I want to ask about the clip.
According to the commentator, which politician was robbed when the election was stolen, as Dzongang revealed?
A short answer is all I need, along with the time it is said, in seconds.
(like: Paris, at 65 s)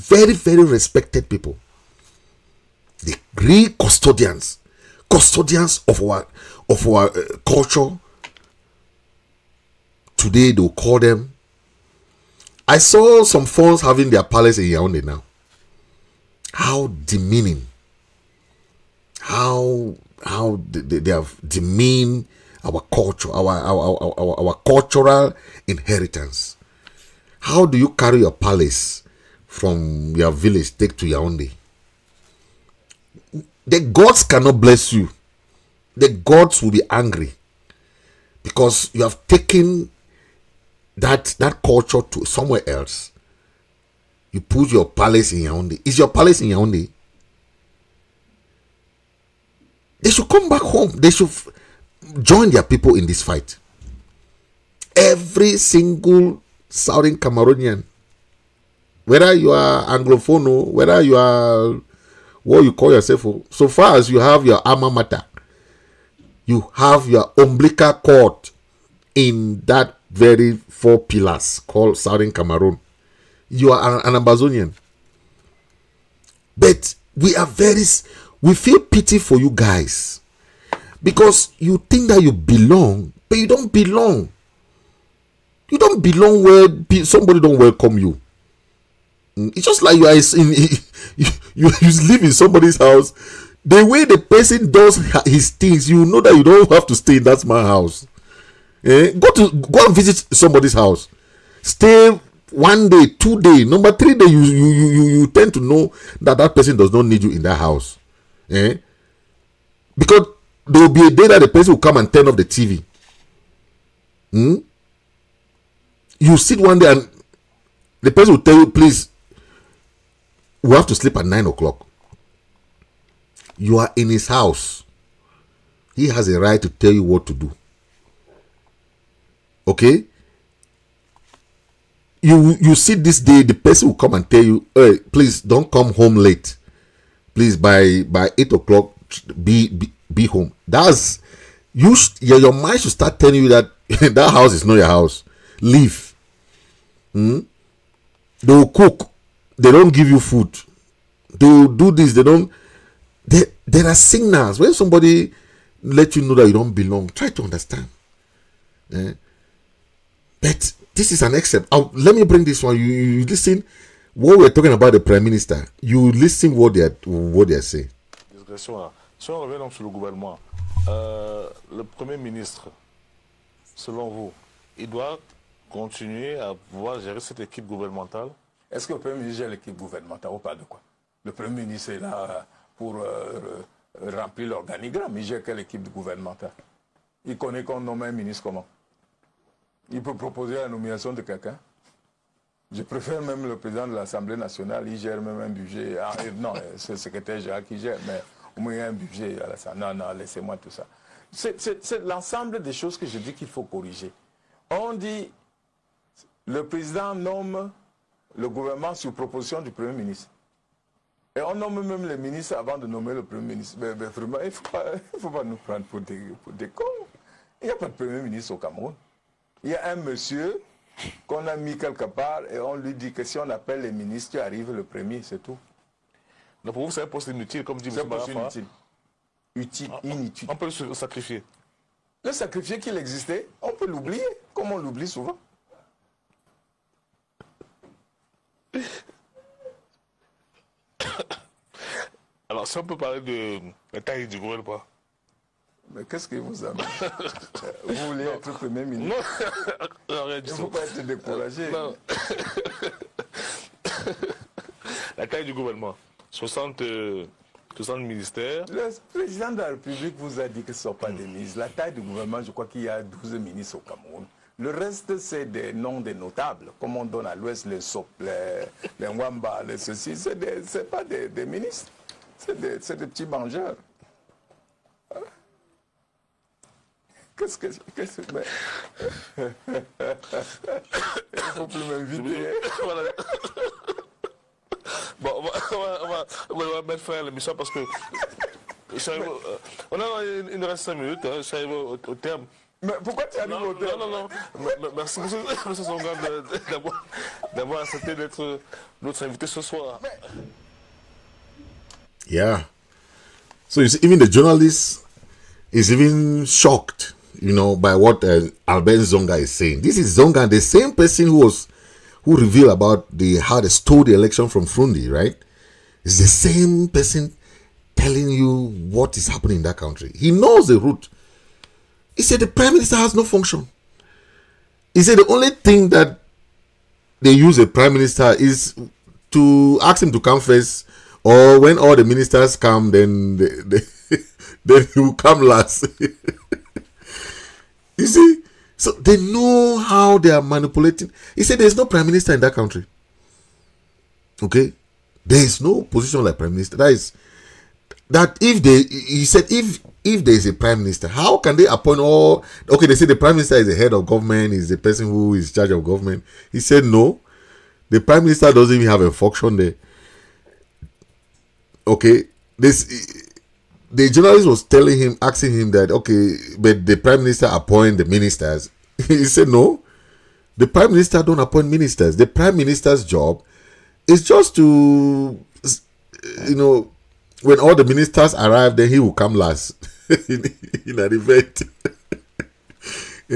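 Fru Ndi, at 314 s.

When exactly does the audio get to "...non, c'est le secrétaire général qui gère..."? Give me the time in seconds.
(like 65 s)
196 s.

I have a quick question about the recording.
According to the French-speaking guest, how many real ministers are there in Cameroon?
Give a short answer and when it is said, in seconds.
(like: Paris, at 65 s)
12, at 263 s.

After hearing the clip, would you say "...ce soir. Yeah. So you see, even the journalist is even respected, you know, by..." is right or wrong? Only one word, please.
wrong.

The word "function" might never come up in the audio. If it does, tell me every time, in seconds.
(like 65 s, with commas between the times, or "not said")
323 s, 359 s.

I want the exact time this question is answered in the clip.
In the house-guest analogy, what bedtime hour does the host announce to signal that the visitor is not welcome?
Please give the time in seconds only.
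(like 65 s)
121 s.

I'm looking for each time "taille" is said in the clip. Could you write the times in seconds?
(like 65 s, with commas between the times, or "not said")
243 s, 255 s, 261 s.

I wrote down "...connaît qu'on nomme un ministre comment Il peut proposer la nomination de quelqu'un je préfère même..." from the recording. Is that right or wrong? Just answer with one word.
right.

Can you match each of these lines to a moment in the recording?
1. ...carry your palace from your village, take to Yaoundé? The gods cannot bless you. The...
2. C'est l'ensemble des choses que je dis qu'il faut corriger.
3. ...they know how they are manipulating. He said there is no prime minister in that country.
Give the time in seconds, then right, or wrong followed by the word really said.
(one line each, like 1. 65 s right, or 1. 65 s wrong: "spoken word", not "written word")
1. 27 s right
2. 201 s right
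3. 338 s right.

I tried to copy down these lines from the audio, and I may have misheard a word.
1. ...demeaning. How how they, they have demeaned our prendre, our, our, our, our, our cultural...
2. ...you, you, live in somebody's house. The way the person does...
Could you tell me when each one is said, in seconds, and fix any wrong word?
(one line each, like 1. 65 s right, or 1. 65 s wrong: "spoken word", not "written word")
1. 16 s wrong: "culture", not "prendre"
2. 91 s right.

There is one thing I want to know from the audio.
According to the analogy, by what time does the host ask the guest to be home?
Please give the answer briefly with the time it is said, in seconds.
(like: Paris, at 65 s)
8 o'clock, at 138 s.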